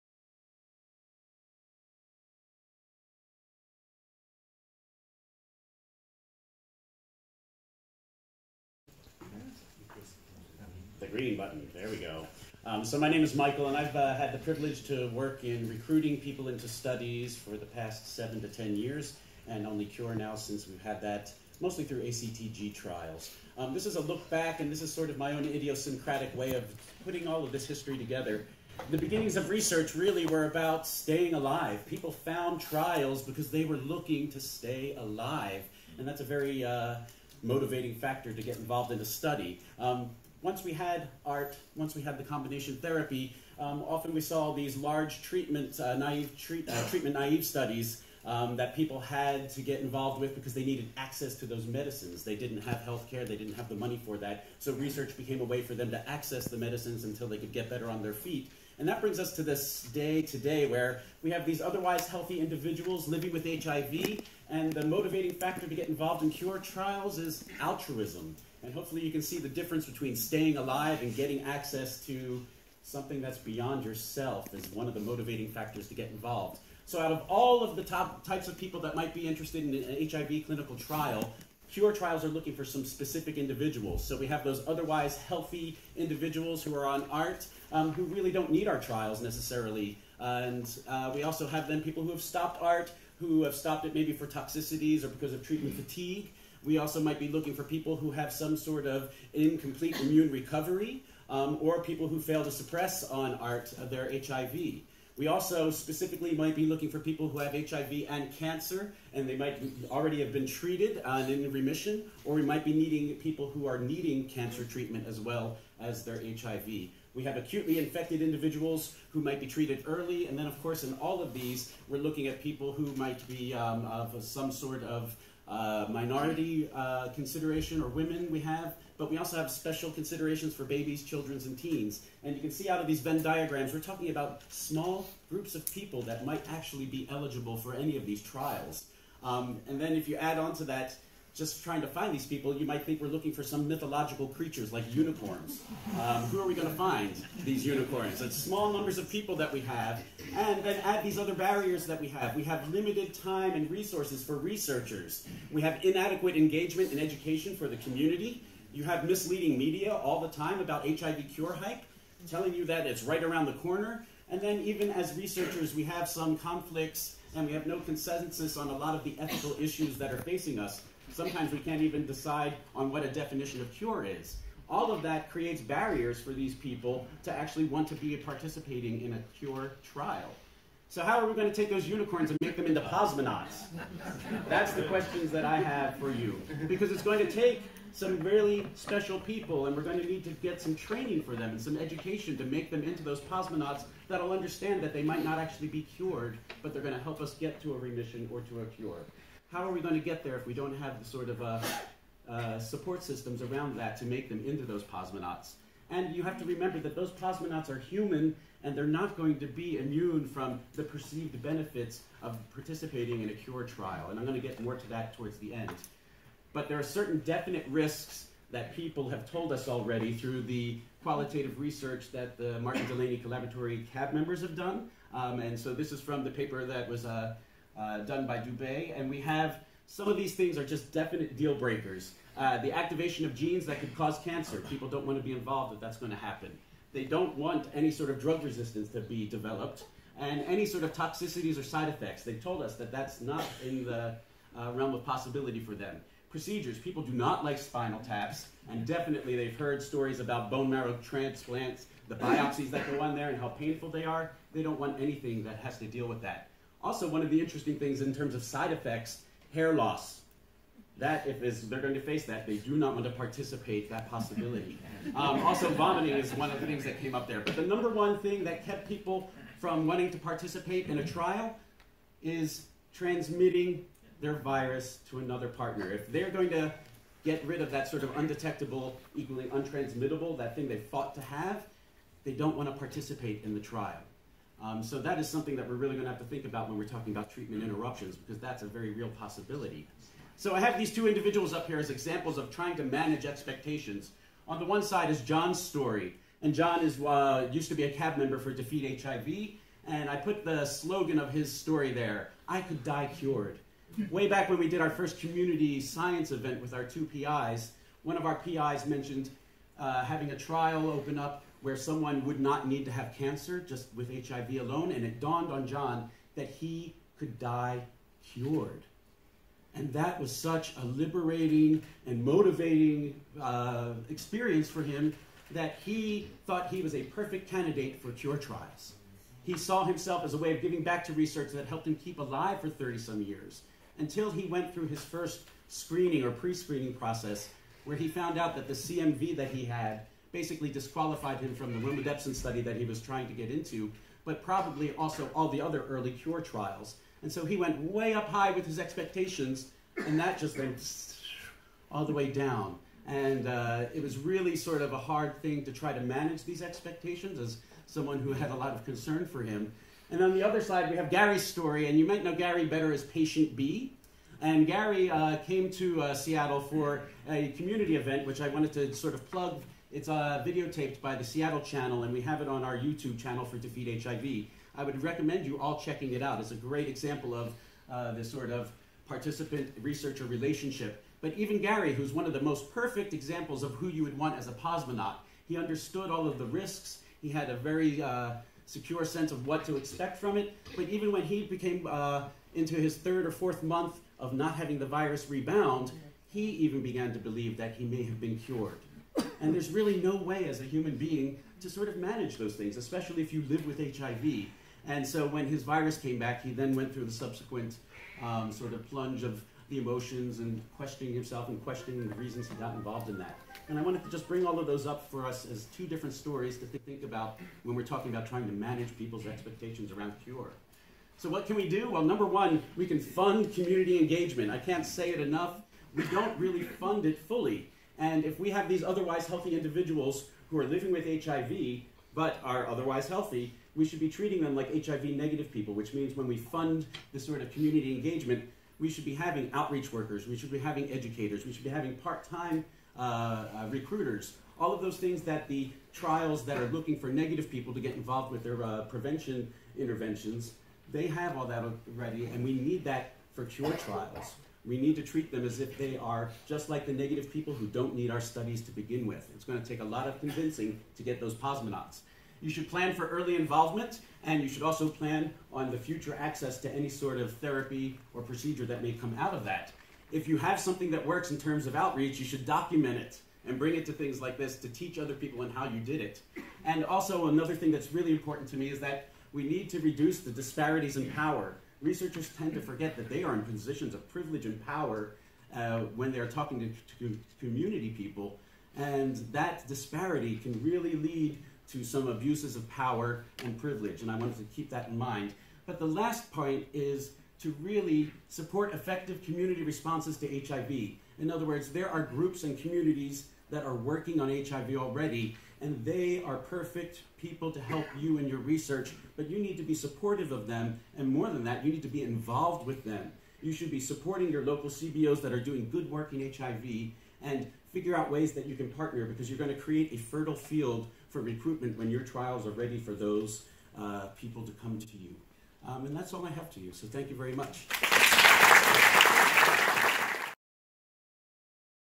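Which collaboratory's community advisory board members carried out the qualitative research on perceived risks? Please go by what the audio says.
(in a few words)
Martin Delaney Collaboratory.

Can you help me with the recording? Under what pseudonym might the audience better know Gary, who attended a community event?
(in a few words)
Patient B.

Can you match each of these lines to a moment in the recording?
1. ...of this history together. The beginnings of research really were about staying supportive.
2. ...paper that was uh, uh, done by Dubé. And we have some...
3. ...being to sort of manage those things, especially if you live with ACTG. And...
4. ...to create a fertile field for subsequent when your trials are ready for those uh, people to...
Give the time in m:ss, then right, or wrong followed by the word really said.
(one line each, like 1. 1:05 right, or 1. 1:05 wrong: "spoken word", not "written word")
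1. 0:27 wrong: "alive", not "supportive"
2. 3:46 right
3. 6:40 wrong: "HIV", not "ACTG"
4. 8:39 wrong: "recruitment", not "subsequent".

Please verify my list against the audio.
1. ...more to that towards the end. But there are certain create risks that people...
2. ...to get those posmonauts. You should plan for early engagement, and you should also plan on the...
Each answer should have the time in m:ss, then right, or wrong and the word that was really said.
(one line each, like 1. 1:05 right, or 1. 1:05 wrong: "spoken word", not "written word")
1. 3:34 wrong: "definite", not "create"
2. 7:40 wrong: "involvement", not "engagement".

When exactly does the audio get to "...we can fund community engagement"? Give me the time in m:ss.
7:02.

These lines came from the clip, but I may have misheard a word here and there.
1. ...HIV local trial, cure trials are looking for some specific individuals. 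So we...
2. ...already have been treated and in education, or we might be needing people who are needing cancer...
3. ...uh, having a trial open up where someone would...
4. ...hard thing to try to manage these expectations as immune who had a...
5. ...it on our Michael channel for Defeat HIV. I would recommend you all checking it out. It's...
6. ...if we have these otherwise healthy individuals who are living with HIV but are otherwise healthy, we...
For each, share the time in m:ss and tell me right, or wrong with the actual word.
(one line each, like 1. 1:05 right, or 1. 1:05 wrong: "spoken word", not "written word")
1. 1:20 wrong: "clinical", not "local"
2. 1:49 wrong: "remission", not "education"
3. 5:09 right
4. 5:54 wrong: "someone", not "immune"
5. 6:12 wrong: "YouTube", not "Michael"
6. 7:08 right.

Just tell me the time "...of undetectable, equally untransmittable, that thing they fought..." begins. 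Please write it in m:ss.
4:38.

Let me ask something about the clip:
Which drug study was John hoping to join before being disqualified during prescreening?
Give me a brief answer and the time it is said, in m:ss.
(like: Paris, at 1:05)
romidepsin, at 5:41.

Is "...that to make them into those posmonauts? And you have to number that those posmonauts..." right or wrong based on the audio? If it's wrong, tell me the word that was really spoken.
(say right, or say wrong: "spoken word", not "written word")
wrong: "remember", not "number".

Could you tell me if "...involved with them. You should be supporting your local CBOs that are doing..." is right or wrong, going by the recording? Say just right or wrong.
right.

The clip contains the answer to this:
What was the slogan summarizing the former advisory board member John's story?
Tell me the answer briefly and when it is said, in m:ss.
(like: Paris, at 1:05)
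I could die cured, at 5:02.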